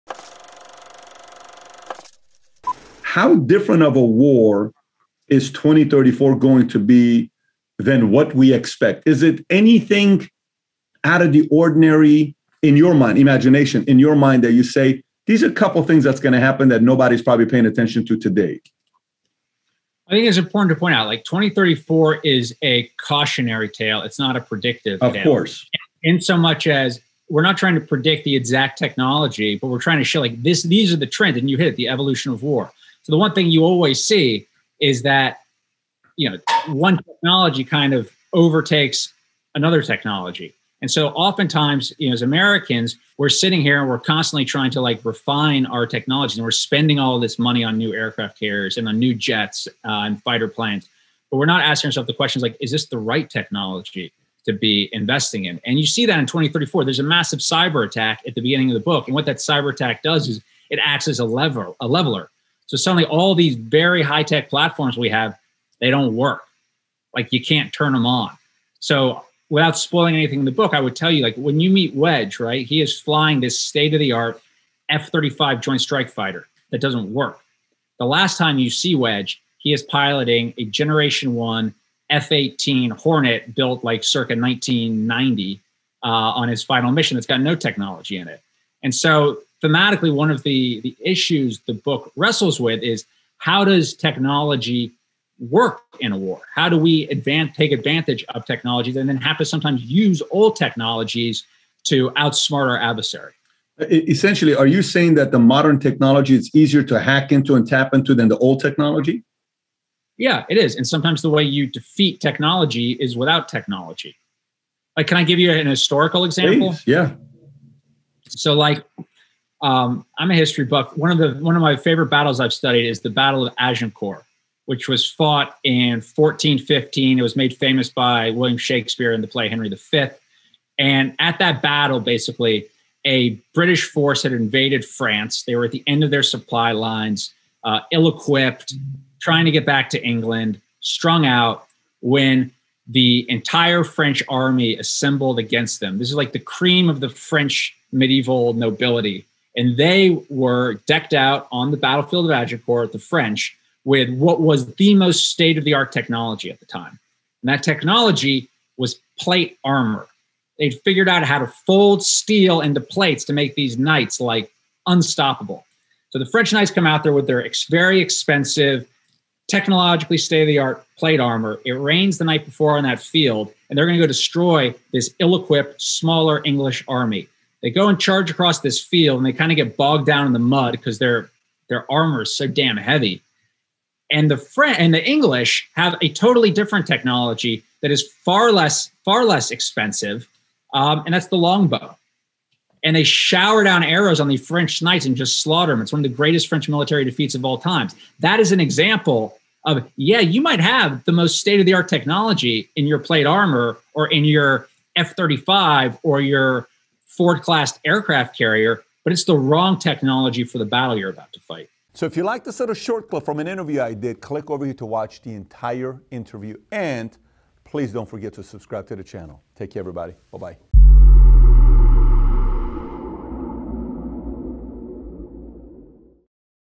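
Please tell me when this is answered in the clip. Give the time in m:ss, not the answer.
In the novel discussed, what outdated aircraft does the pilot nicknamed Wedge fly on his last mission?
1:20.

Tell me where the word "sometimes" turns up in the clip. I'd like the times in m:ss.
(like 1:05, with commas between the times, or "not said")
1:39, 1:50.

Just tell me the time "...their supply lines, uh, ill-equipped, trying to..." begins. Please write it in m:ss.
2:16.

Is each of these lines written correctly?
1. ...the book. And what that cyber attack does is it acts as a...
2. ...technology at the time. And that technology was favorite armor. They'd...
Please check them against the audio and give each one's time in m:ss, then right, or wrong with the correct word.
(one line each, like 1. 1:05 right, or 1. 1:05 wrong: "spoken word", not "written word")
1. 0:58 right
2. 2:35 wrong: "plate", not "favorite".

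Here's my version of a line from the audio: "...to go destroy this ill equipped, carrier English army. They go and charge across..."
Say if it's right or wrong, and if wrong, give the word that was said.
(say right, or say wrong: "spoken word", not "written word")
wrong: "smaller", not "carrier".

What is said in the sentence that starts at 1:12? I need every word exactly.
He is flying this state of the art F-35 Joint Strike Fighter that doesn't work.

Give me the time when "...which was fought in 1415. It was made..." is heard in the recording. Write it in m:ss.
2:04.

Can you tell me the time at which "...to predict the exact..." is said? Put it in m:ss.
0:27.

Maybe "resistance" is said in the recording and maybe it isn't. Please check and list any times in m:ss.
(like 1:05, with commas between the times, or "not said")
not said.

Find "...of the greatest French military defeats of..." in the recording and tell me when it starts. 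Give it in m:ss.
3:16.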